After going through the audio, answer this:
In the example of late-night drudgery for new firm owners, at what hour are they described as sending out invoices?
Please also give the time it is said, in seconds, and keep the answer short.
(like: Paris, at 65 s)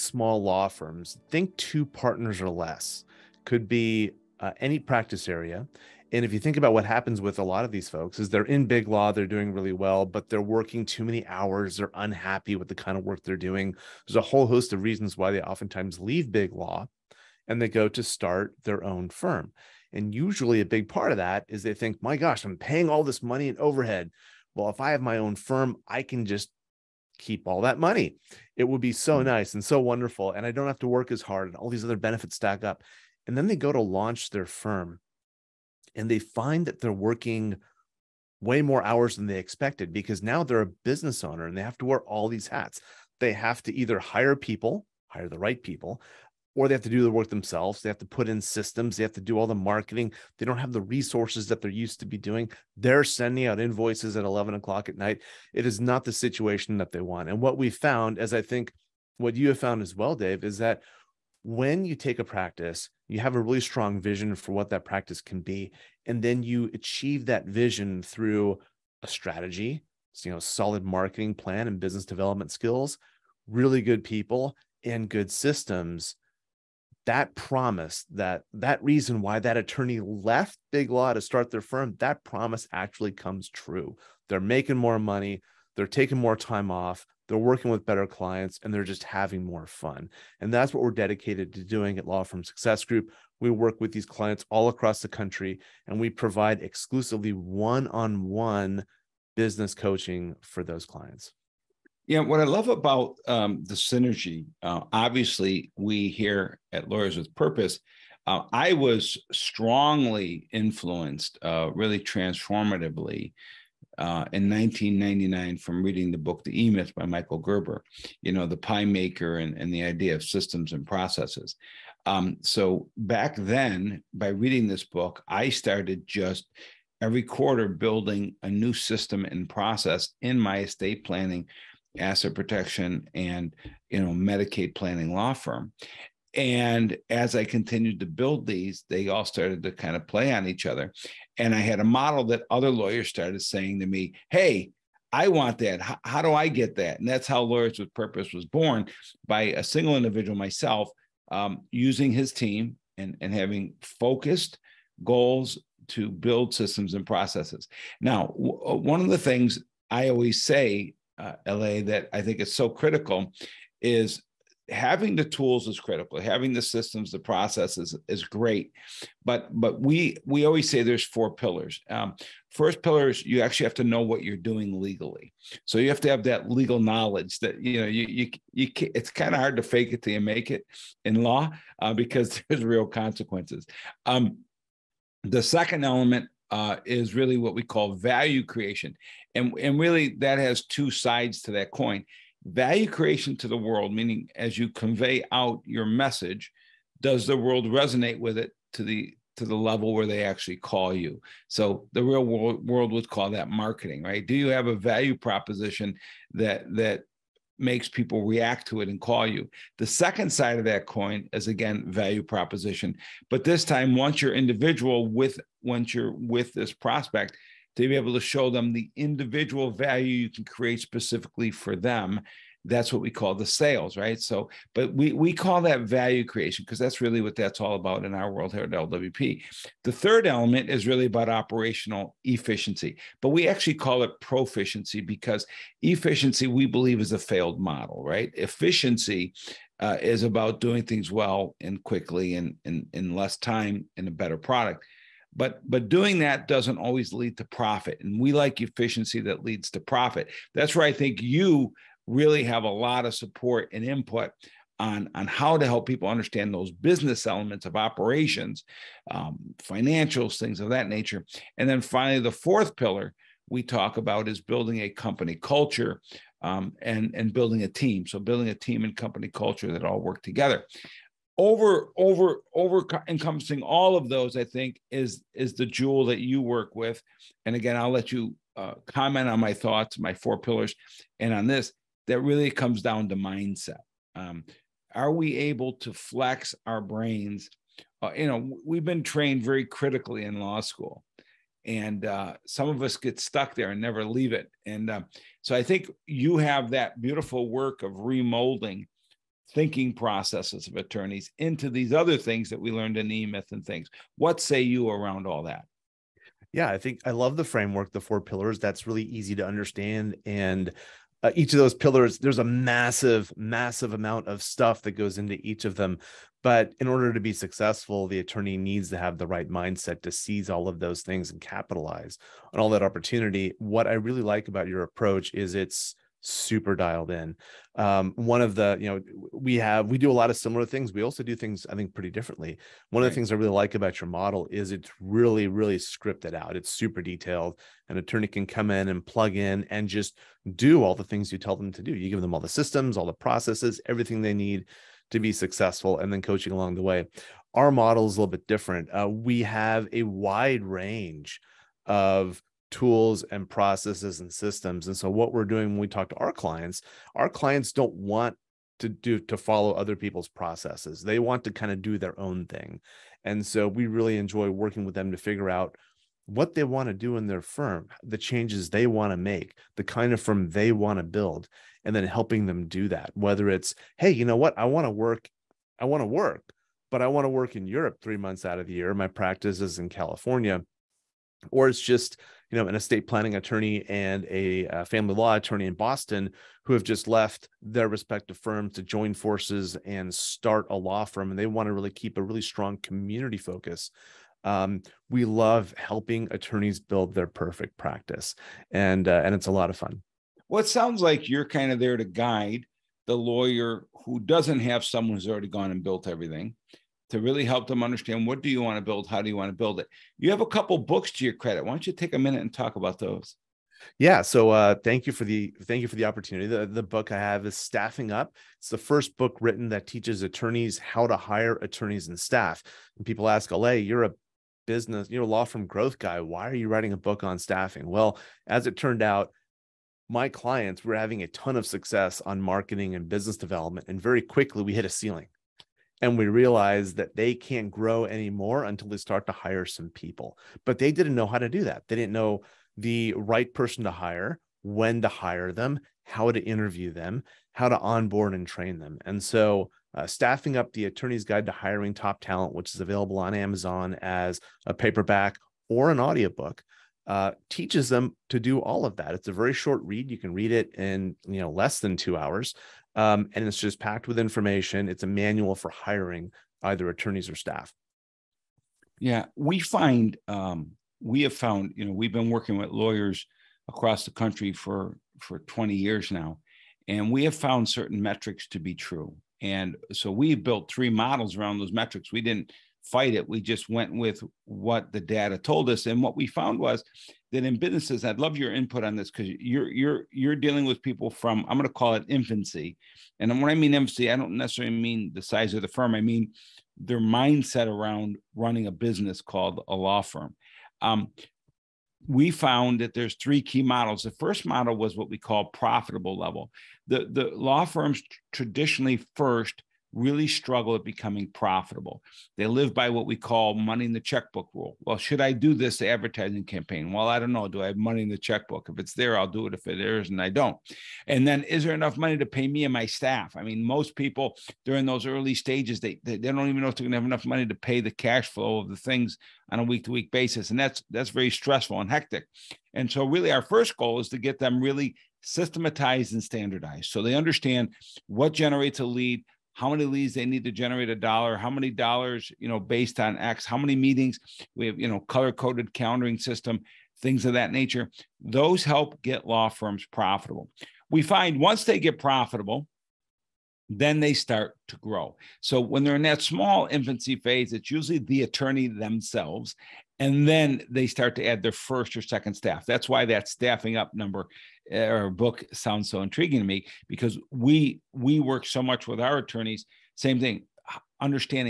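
11 o'clock, at 54 s.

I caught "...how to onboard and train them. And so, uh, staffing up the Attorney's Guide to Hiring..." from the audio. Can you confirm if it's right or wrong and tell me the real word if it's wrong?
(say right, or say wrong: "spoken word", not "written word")
right.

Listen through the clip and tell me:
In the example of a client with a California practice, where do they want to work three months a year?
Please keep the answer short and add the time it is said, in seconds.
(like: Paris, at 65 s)
Europe, at 377 s.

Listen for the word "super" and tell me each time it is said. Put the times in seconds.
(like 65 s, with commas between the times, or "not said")
326 s, 336 s.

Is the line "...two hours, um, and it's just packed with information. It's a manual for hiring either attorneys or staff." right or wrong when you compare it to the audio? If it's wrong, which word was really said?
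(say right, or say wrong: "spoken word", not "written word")
right.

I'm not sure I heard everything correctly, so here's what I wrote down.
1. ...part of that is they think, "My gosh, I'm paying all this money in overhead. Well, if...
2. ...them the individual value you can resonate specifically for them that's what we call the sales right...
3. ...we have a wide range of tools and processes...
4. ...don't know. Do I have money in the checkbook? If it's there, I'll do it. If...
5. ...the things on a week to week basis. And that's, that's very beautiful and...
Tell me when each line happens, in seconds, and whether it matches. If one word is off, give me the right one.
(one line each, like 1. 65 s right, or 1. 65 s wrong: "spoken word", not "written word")
1. 20 s right
2. 218 s wrong: "create", not "resonate"
3. 349 s right
4. 517 s right
5. 528 s wrong: "stressful", not "beautiful".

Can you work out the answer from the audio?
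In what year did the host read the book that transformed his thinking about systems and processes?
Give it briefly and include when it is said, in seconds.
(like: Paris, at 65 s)
1999, at 114 s.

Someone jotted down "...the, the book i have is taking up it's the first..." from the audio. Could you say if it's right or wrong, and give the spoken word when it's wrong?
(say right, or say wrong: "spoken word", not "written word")
wrong: "staffing", not "taking".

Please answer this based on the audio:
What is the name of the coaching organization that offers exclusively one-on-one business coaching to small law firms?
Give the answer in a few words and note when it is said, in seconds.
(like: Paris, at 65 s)
Law Firm Success Group, at 92 s.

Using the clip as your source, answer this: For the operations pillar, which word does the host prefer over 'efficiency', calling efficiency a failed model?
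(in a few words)
proficiency.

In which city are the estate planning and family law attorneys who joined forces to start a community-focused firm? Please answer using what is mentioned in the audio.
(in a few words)
Boston.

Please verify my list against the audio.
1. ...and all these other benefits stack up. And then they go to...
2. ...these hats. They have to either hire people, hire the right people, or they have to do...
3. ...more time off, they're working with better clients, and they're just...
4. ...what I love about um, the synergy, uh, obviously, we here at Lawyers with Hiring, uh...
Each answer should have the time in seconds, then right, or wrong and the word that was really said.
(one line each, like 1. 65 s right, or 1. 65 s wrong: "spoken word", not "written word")
1. 31 s right
2. 42 s right
3. 86 s right
4. 102 s wrong: "Purpose", not "Hiring".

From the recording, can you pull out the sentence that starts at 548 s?
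Those help get law firms profitable.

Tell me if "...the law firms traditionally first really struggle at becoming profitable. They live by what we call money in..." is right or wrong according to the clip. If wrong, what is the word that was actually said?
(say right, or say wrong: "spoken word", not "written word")
right.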